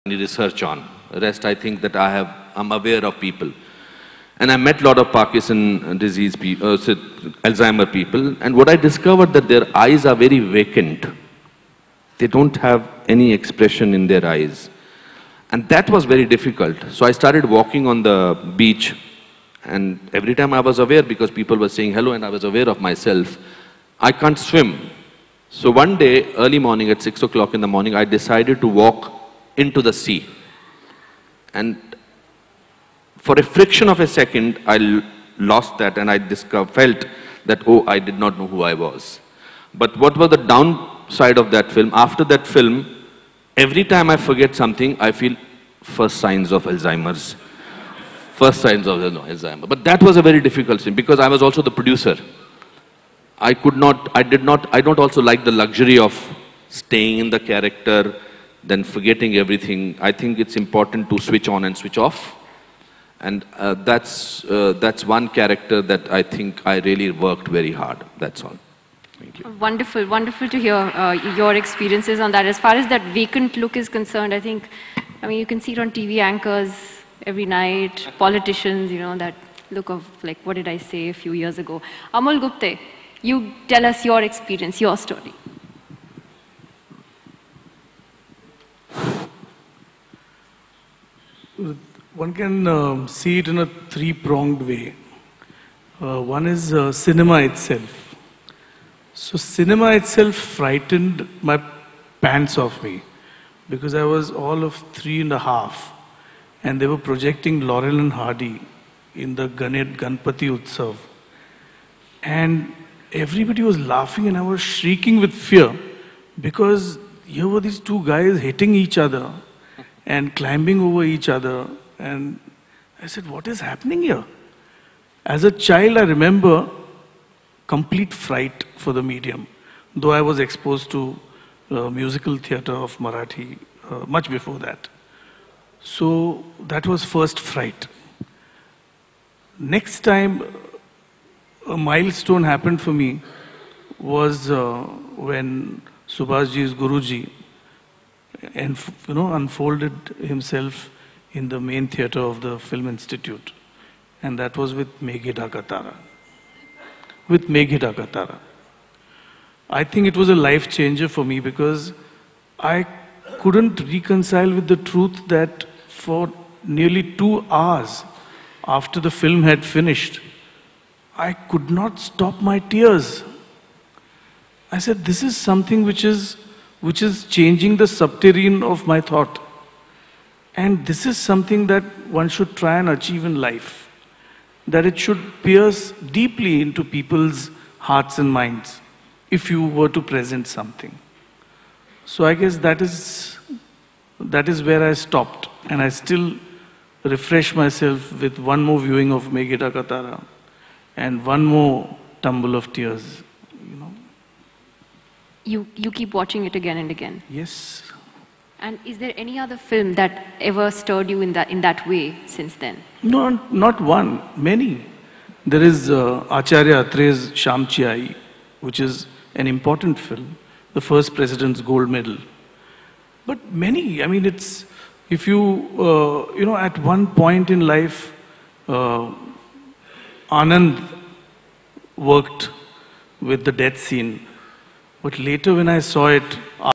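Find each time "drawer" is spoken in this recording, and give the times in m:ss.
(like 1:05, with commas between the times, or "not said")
not said.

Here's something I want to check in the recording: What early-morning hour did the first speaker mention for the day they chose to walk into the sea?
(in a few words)
6 o'clock.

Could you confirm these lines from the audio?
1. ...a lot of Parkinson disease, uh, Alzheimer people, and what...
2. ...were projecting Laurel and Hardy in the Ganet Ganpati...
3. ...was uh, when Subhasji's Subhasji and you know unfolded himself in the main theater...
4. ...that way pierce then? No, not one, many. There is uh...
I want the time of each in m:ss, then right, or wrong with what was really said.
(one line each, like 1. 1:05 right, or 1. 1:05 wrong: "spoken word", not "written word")
1. 0:04 right
2. 1:46 right
3. 2:23 wrong: "Guruji", not "Subhasji"
4. 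3:31 wrong: "since", not "pierce".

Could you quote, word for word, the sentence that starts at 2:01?
And I said, What is happening here?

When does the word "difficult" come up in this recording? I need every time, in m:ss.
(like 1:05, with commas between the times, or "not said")
0:16, 0:50.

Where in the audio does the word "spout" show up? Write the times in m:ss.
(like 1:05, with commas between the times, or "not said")
not said.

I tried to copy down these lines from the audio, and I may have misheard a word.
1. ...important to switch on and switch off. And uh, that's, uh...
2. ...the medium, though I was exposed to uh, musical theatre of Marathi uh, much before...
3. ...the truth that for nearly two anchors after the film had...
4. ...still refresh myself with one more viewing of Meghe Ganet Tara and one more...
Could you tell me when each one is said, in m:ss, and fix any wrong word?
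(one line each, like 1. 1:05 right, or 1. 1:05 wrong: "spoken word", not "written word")
1. 1:00 right
2. 2:08 right
3. 2:44 wrong: "hours", not "anchors"
4. 3:15 wrong: "Dhaka", not "Ganet".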